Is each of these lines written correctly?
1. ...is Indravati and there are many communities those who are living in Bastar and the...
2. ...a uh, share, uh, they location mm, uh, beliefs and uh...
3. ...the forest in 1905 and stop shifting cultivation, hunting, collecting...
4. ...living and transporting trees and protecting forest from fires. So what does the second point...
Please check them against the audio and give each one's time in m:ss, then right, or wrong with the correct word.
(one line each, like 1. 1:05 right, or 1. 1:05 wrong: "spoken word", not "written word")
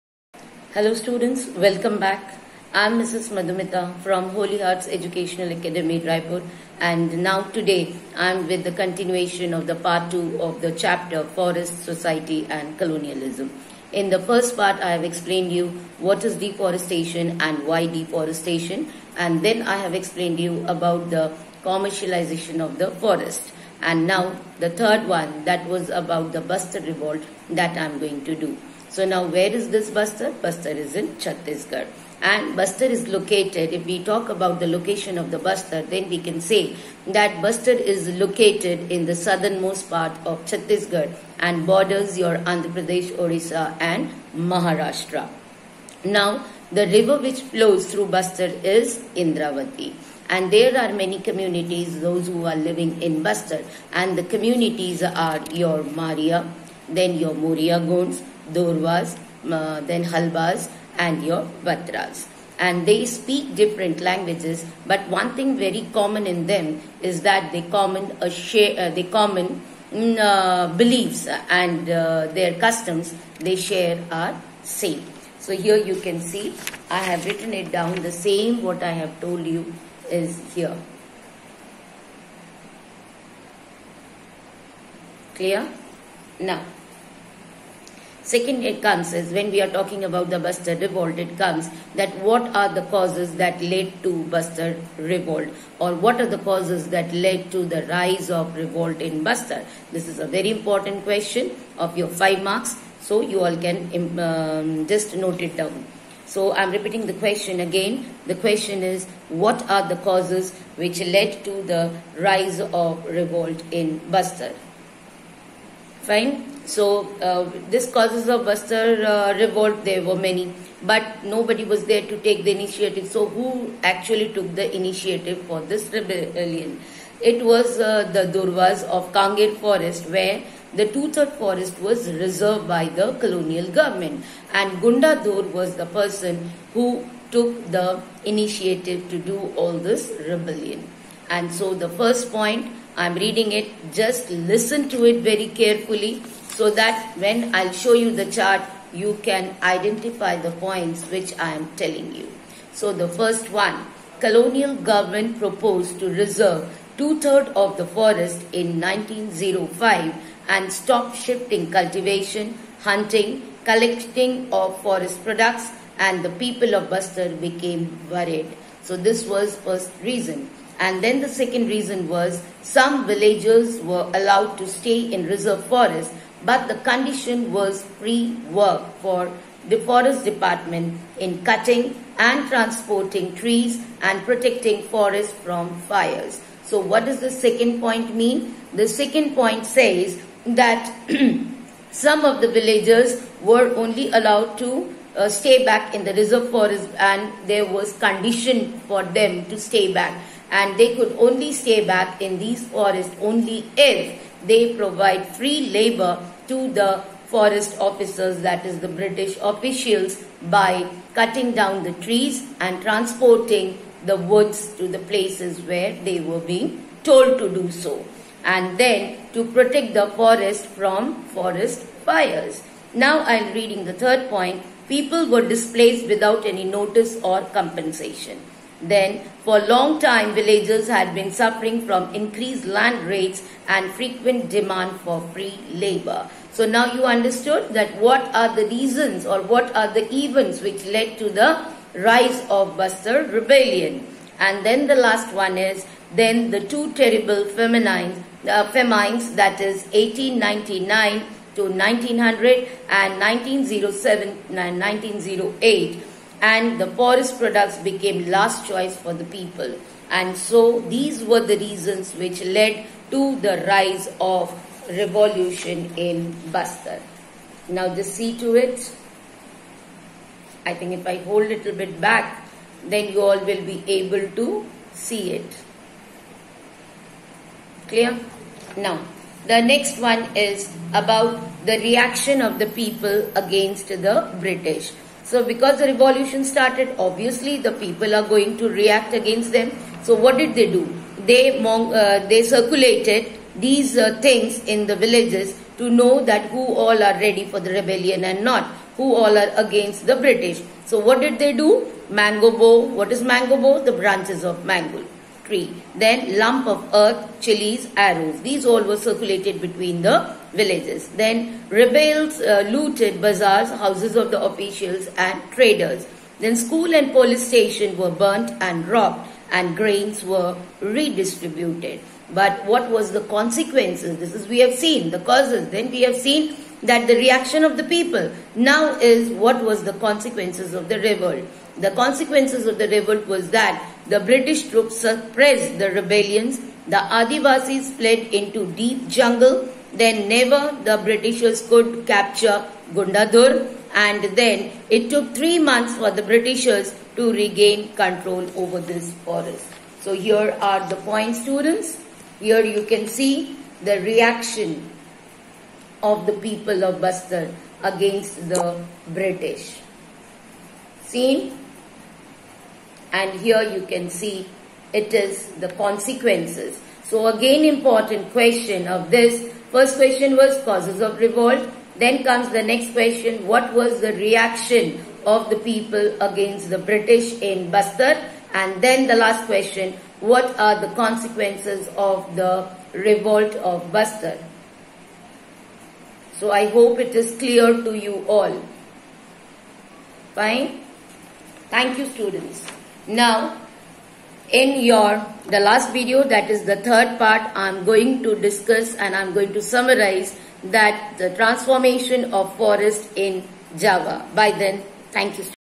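1. 0:48 right
2. 1:08 wrong: "common", not "location"
3. 2:37 right
4. 3:01 wrong: "cutting", not "living".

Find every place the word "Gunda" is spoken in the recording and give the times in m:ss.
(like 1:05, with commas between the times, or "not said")
2:14, 5:42.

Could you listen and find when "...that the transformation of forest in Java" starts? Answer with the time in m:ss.
6:40.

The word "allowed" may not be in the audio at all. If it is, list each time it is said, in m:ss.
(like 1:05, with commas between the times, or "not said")
2:54, 3:14.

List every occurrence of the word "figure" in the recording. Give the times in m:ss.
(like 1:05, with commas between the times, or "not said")
not said.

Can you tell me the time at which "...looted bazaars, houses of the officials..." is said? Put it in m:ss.
5:12.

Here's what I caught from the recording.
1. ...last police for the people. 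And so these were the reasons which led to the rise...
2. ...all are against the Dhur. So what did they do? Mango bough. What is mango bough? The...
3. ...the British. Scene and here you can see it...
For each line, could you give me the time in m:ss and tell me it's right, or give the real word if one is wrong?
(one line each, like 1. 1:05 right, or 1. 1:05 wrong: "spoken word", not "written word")
1. 4:18 wrong: "choice", not "police"
2. 4:59 wrong: "British", not "Dhur"
3. 5:58 right.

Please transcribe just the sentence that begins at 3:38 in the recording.
And then to protect the forest from forest fires.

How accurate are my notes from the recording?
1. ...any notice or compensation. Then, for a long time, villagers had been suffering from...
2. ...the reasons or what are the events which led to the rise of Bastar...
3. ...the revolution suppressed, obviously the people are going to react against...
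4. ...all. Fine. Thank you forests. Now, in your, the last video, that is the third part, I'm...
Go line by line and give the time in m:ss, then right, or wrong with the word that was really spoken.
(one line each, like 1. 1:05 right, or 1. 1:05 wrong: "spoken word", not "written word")
1. 3:46 right
2. 3:58 right
3. 4:45 wrong: "started", not "suppressed"
4. 6:28 wrong: "students", not "forests".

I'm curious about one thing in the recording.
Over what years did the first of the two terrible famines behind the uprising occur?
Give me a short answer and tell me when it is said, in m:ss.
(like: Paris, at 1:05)
1899 to 1900, at 4:09.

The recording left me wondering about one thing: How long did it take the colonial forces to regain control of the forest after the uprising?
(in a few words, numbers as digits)
3 months.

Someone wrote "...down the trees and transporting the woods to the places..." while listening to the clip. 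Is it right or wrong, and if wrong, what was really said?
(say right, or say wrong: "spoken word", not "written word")
right.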